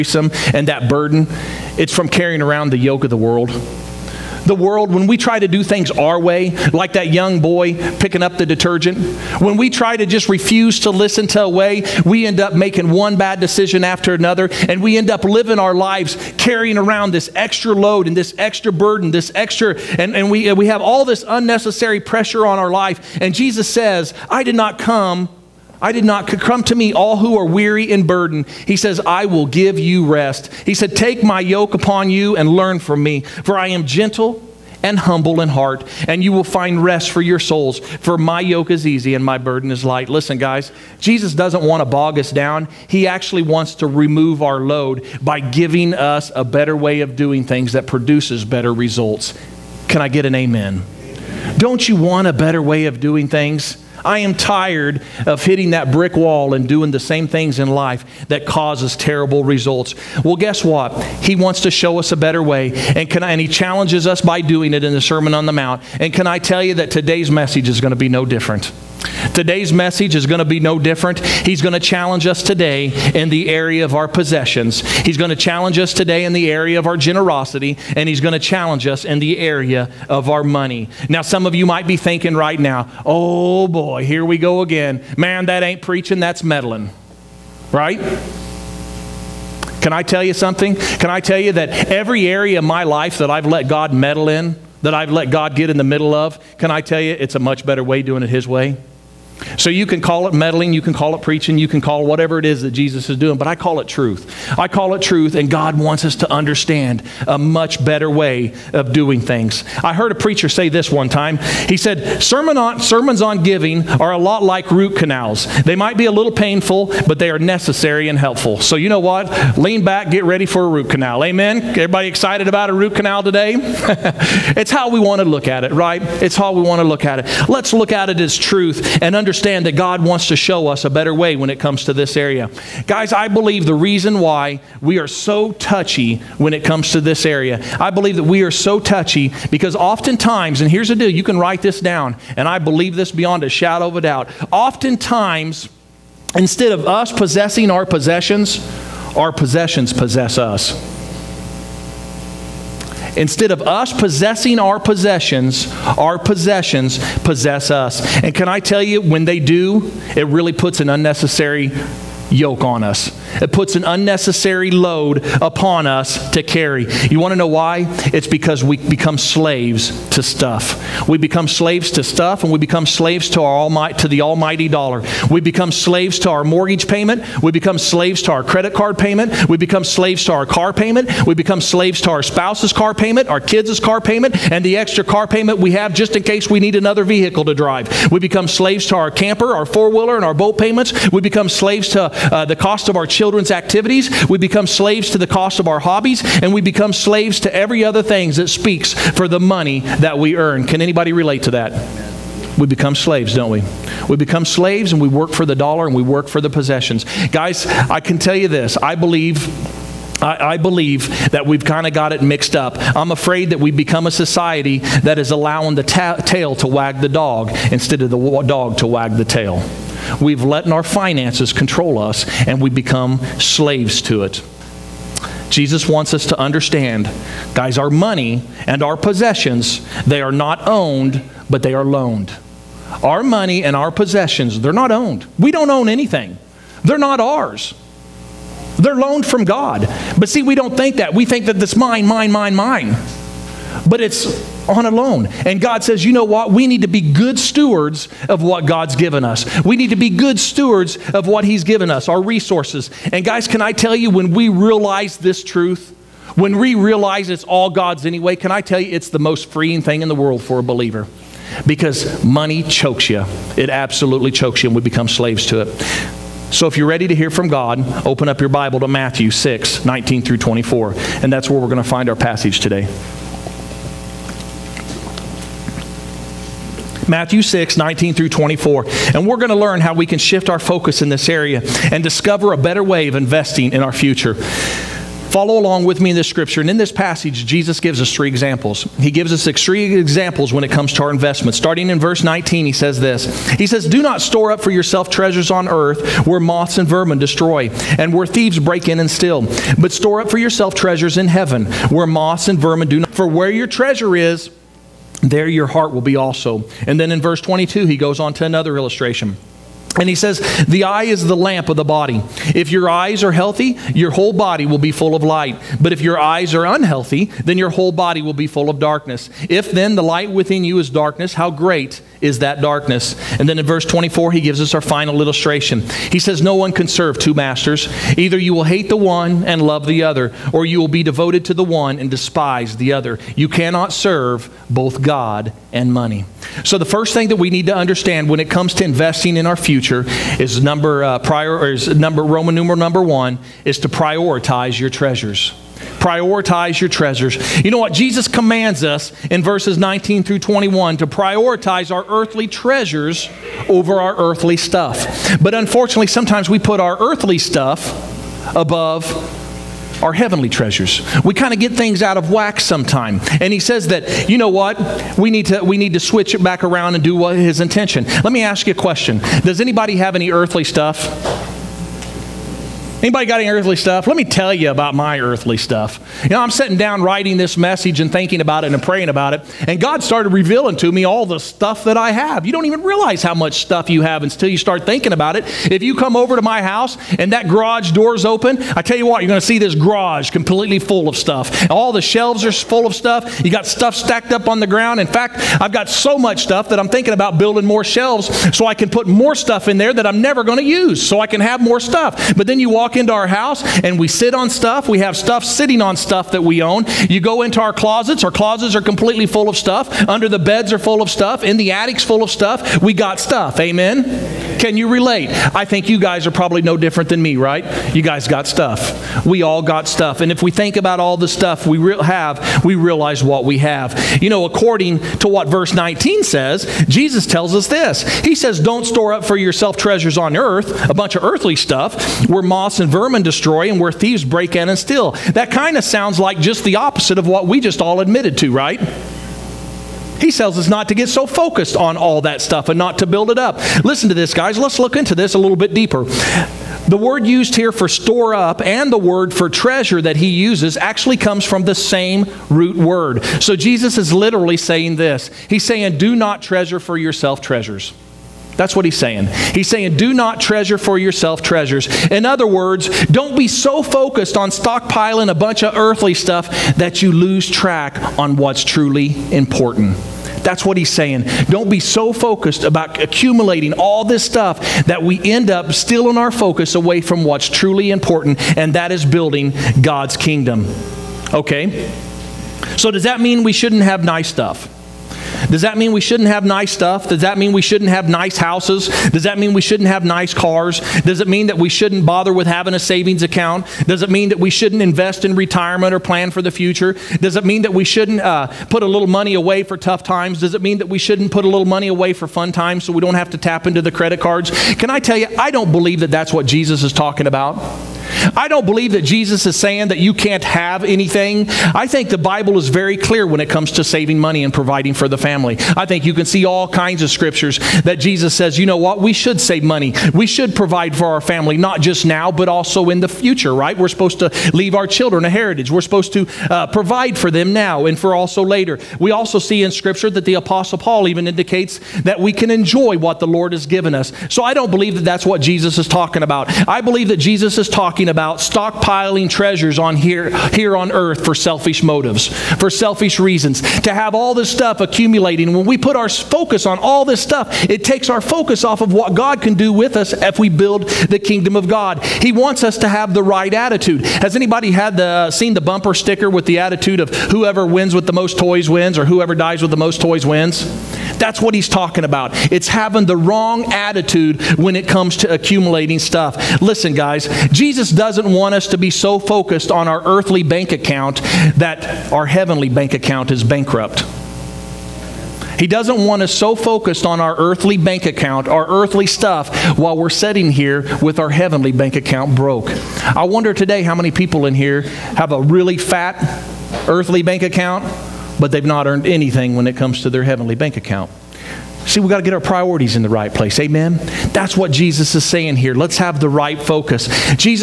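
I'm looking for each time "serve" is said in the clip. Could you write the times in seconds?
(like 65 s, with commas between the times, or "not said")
326 s, 333 s.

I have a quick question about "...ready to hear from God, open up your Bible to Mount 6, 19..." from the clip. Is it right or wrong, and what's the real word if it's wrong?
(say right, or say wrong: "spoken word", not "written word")
wrong: "Matthew", not "Mount".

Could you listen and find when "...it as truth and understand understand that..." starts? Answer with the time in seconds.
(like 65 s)
128 s.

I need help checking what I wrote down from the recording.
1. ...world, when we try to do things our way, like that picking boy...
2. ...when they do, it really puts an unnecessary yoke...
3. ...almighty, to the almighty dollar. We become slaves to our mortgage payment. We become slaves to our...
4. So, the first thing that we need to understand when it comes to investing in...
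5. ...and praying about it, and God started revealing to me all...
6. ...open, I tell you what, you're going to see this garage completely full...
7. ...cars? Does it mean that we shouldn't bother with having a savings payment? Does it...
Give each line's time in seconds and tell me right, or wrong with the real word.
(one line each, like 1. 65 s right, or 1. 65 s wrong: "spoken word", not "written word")
1. 4 s wrong: "young", not "picking"
2. 159 s right
3. 173 s right
4. 336 s right
5. 378 s right
6. 388 s right
7. 490 s wrong: "account", not "payment".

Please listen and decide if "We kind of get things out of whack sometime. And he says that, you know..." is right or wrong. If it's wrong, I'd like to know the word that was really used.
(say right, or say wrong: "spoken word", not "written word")
right.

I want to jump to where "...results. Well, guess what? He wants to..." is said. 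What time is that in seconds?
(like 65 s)
59 s.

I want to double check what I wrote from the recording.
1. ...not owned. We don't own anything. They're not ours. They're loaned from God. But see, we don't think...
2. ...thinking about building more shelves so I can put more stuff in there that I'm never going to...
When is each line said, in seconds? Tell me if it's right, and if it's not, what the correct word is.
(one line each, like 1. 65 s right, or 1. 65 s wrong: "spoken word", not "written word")
1. 234 s right
2. 396 s right.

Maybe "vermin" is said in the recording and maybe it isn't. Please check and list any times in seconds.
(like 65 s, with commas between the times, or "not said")
296 s, 302 s, 432 s.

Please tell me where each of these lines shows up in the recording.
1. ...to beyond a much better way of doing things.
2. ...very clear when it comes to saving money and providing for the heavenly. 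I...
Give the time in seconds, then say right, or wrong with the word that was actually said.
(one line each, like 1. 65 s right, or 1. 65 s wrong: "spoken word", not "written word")
1. 106 s wrong: "understand", not "beyond"
2. 512 s wrong: "family", not "heavenly".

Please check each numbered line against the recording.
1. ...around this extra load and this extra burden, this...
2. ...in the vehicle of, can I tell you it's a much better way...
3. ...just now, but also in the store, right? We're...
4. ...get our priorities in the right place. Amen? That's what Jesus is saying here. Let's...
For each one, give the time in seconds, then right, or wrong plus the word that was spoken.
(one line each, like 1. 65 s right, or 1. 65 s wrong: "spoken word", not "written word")
1. 16 s right
2. 95 s wrong: "middle", not "vehicle"
3. 521 s wrong: "future", not "store"
4. 592 s right.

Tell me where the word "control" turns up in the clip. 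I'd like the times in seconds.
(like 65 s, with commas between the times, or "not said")
221 s.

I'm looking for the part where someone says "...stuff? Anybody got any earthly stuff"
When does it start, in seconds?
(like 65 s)
370 s.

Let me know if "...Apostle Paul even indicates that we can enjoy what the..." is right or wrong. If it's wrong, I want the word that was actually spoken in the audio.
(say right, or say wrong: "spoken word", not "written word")
right.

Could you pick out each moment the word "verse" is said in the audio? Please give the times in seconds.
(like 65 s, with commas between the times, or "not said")
292 s, 307 s, 323 s, 349 s, 425 s.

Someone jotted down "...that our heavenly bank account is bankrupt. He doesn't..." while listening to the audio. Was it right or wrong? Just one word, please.
right.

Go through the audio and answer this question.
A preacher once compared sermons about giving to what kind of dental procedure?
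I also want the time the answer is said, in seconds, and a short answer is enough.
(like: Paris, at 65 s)
root canals, at 114 s.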